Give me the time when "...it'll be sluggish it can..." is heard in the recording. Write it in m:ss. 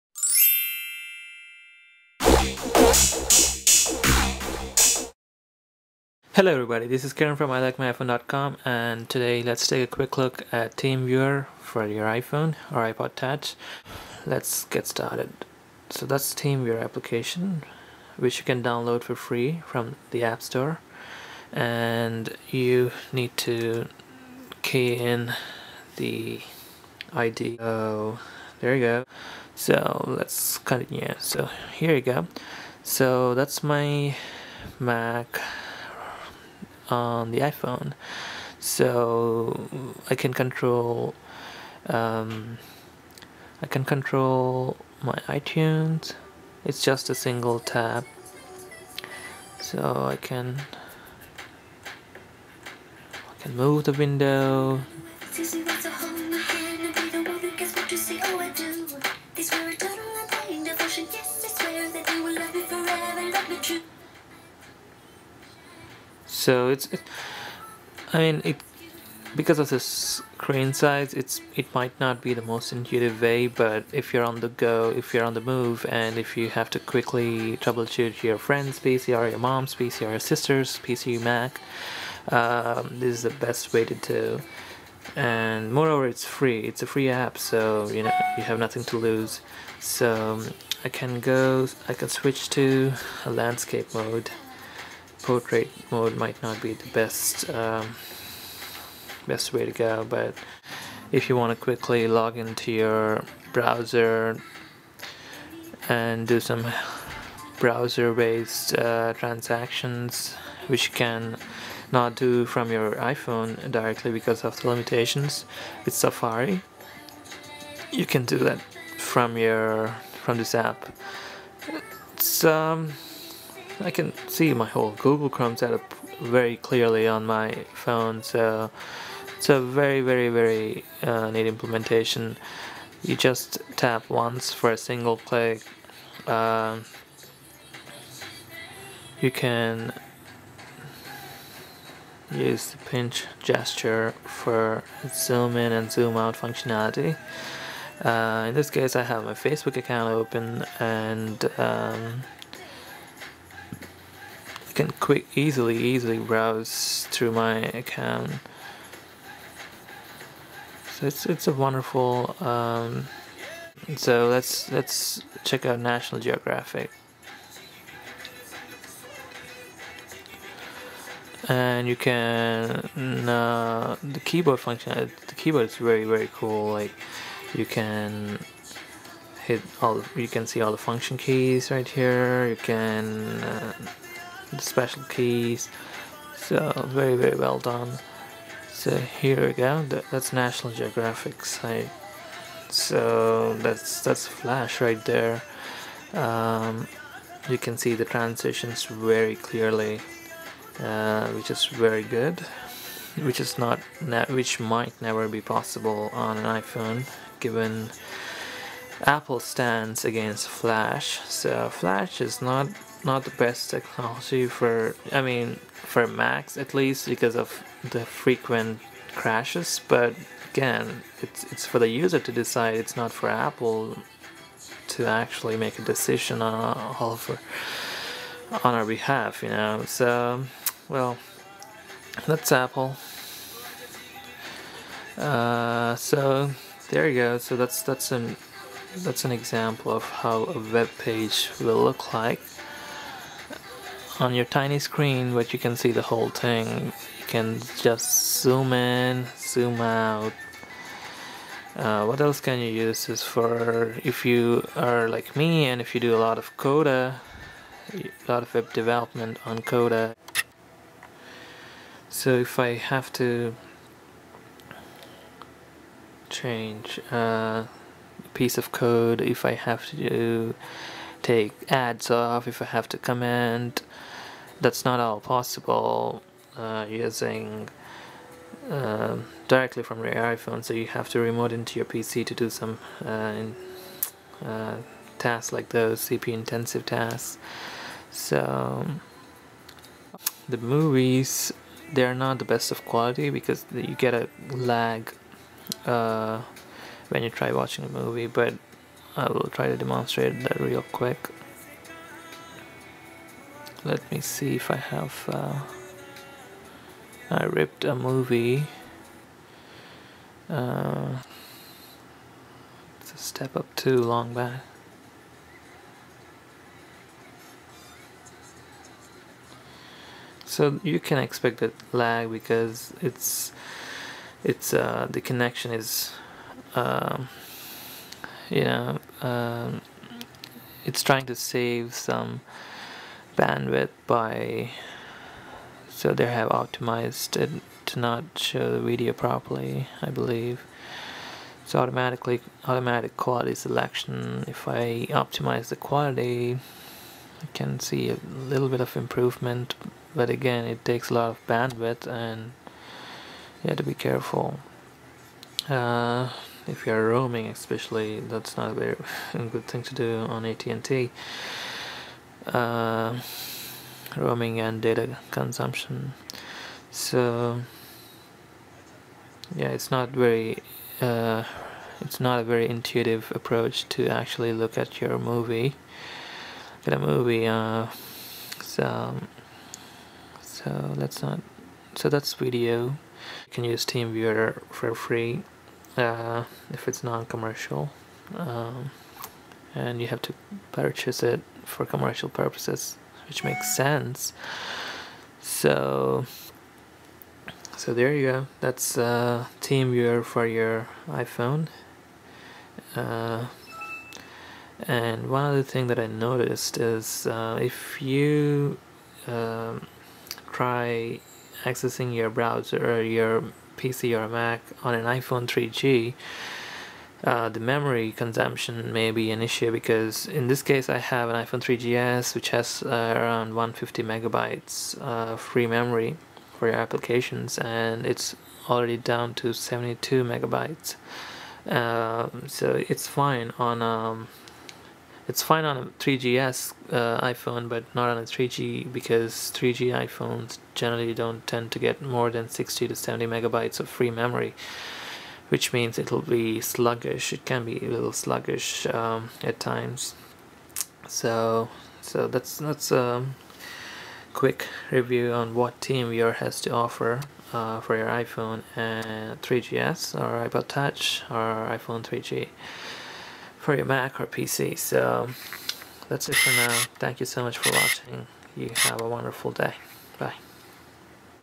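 7:25.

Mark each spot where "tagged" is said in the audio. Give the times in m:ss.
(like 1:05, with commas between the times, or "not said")
not said.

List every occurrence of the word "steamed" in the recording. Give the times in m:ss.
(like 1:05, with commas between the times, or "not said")
not said.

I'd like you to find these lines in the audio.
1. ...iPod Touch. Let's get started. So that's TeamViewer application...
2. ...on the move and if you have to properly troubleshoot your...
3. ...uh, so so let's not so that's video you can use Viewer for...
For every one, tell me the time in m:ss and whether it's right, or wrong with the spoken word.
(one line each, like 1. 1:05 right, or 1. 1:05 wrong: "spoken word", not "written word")
1. 0:12 right
2. 1:15 wrong: "quickly", not "properly"
3. 6:17 wrong: "TeamViewer", not "Viewer".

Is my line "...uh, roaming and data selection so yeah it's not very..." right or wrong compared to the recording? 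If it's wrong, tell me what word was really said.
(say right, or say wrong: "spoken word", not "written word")
wrong: "consumption", not "selection".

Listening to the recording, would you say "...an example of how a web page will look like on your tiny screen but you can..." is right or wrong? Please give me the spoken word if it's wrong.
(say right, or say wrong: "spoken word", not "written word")
right.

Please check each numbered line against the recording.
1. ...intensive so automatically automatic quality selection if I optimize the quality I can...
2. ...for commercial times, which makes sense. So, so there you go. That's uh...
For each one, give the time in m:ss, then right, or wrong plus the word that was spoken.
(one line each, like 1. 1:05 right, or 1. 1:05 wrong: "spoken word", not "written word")
1. 5:40 wrong: "believe", not "intensive"
2. 6:31 wrong: "purposes", not "times".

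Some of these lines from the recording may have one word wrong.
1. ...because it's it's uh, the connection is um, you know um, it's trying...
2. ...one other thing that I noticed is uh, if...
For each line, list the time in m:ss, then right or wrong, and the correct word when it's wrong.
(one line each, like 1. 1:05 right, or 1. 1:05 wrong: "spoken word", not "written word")
1. 5:22 right
2. 6:45 right.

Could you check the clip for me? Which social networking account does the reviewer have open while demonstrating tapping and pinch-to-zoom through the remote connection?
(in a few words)
Facebook.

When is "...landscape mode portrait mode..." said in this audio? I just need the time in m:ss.
1:33.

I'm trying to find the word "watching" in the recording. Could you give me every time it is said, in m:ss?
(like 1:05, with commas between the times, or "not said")
4:57, 7:47.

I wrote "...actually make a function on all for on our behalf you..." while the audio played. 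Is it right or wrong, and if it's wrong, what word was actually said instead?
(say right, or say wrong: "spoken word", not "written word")
wrong: "decision", not "function".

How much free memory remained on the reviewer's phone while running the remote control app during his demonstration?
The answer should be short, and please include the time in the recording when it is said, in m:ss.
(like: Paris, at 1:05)
72 megabytes, at 7:09.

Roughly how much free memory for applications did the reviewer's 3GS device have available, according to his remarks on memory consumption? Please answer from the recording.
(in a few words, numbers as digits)
150 megabytes.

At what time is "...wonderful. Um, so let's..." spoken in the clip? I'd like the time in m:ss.
2:41.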